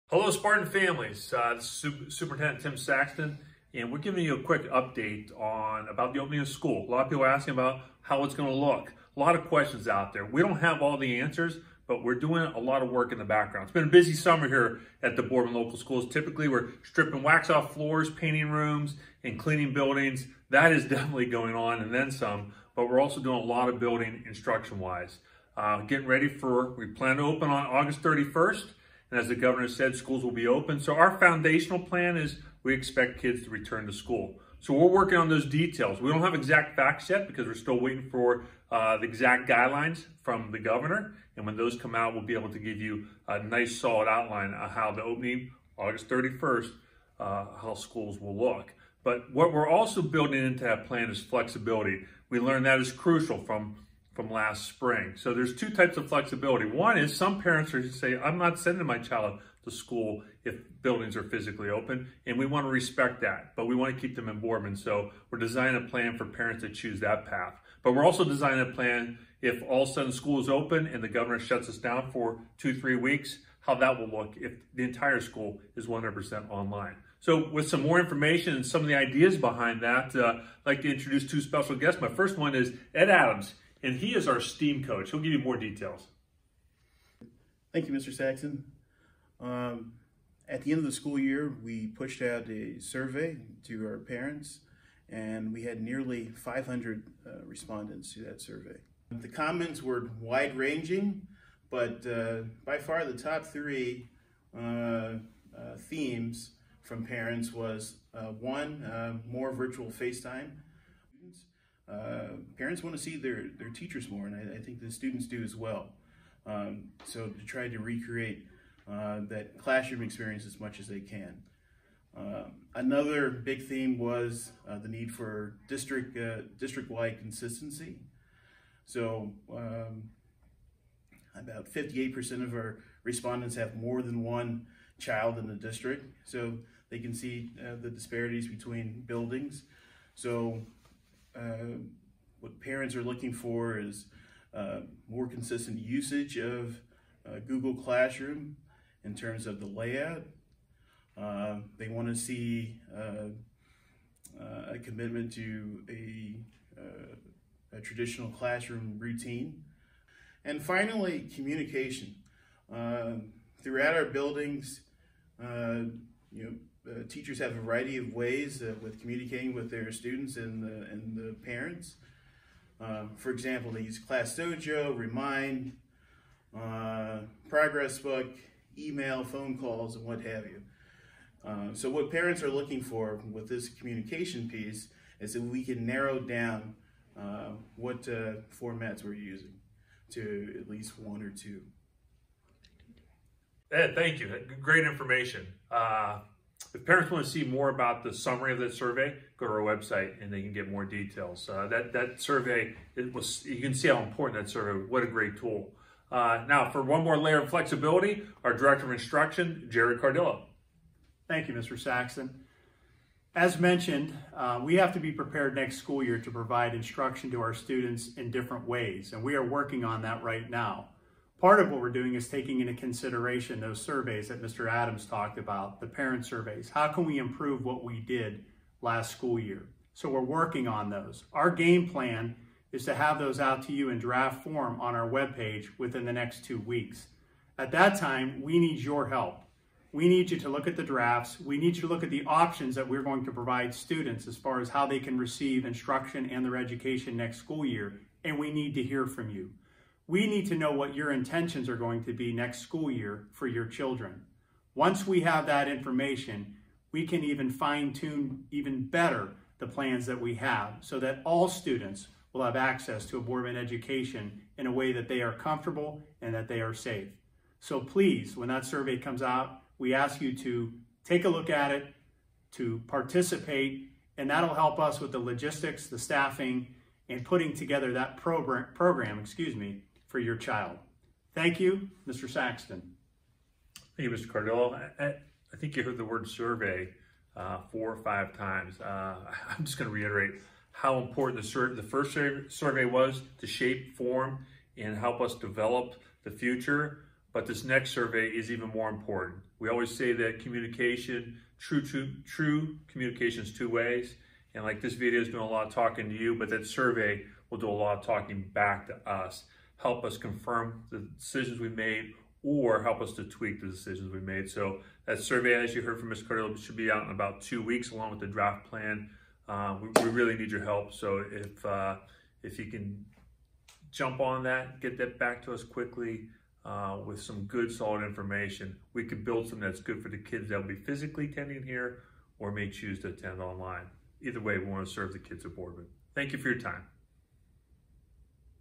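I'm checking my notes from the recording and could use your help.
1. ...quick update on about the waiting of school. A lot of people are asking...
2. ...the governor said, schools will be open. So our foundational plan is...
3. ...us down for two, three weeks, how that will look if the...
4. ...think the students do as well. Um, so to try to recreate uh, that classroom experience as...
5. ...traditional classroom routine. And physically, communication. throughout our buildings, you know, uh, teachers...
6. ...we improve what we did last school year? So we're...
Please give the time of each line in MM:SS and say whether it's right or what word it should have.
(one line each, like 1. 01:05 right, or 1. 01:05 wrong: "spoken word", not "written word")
1. 00:04 wrong: "opening", not "waiting"
2. 00:29 right
3. 01:11 right
4. 01:54 right
5. 02:37 wrong: "finally", not "physically"
6. 03:47 right.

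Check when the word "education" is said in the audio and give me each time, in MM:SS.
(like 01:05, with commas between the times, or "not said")
04:06, 04:23.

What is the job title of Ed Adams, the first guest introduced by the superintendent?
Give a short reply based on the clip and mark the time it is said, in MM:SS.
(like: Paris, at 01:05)
STEAM coach, at 01:24.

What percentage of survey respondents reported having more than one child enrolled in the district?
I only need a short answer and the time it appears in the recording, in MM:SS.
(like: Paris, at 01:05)
58%, at 02:11.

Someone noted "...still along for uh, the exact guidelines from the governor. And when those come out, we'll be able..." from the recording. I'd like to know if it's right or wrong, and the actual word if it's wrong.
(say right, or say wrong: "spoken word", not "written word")
wrong: "waiting", not "along".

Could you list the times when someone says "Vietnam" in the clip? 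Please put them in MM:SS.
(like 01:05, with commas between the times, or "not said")
not said.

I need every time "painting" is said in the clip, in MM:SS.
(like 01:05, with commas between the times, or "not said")
00:18.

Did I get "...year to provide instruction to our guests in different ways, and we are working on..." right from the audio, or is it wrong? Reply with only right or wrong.
wrong.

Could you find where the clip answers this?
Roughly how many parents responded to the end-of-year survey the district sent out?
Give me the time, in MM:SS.
01:36.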